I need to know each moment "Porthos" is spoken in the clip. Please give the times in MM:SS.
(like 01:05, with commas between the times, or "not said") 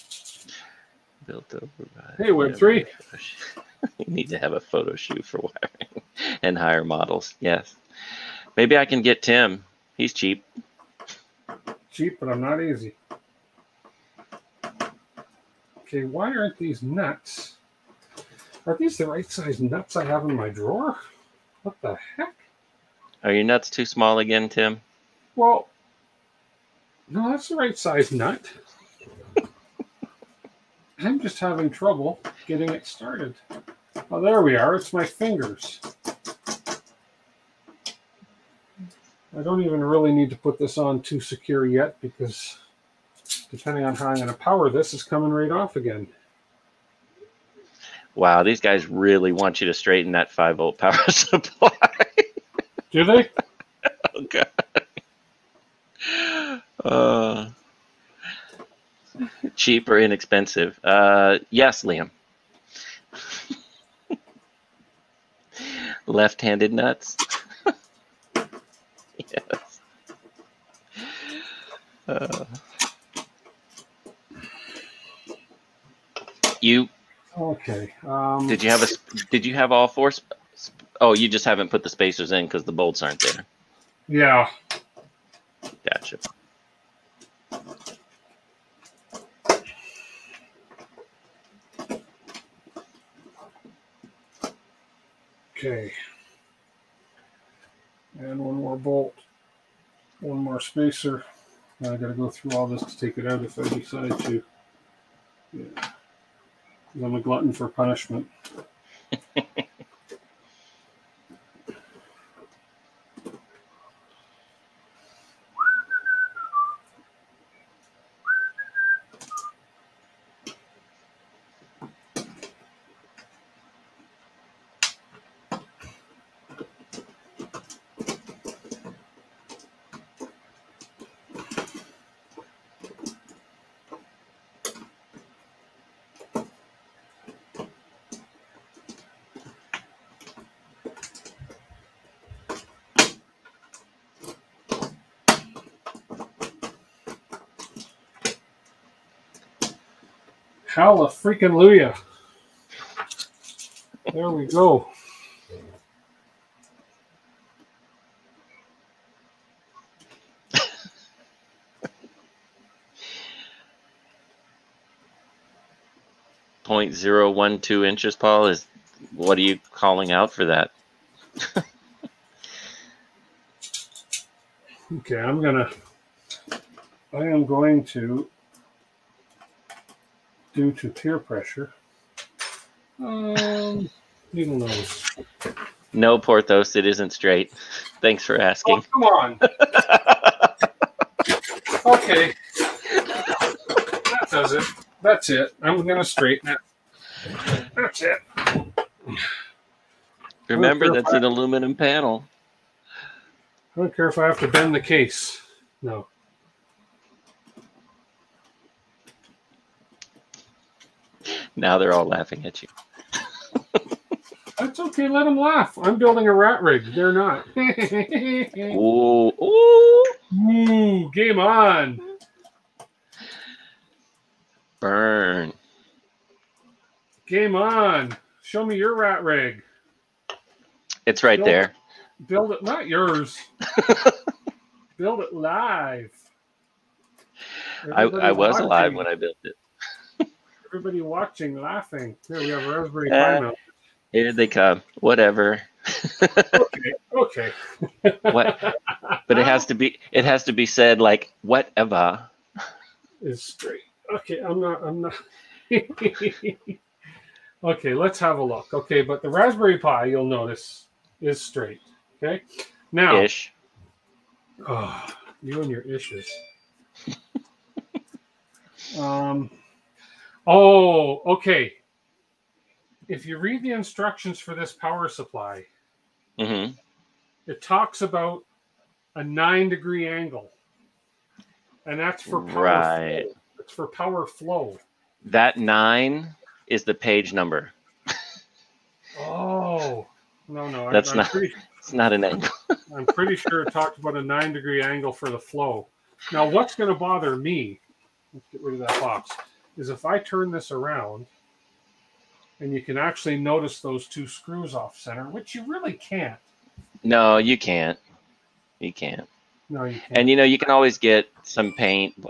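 03:06.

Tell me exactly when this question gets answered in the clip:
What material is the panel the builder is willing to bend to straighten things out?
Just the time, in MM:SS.
03:21.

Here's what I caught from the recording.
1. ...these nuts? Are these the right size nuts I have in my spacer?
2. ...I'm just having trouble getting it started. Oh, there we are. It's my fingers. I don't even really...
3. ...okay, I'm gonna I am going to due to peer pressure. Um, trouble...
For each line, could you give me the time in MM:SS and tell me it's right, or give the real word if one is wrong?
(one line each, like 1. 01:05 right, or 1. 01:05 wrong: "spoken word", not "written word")
1. 00:16 wrong: "drawer", not "spacer"
2. 00:30 right
3. 02:54 wrong: "needle", not "trouble".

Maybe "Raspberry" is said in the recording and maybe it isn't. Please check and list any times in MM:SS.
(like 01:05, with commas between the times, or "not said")
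04:02, 04:19.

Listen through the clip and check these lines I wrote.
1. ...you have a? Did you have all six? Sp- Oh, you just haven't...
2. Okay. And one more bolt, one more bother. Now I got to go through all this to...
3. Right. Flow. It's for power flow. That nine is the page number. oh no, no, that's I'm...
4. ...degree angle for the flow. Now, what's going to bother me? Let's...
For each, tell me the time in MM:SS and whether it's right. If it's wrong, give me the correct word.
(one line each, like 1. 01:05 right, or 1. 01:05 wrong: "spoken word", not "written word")
1. 01:18 wrong: "four", not "six"
2. 01:35 wrong: "spacer", not "bother"
3. 04:42 right
4. 04:54 right.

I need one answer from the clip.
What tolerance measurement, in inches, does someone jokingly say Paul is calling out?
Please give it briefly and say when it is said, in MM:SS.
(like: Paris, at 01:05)
0.012 inches, at 02:46.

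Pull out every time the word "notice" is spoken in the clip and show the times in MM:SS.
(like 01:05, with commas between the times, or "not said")
04:20, 05:03.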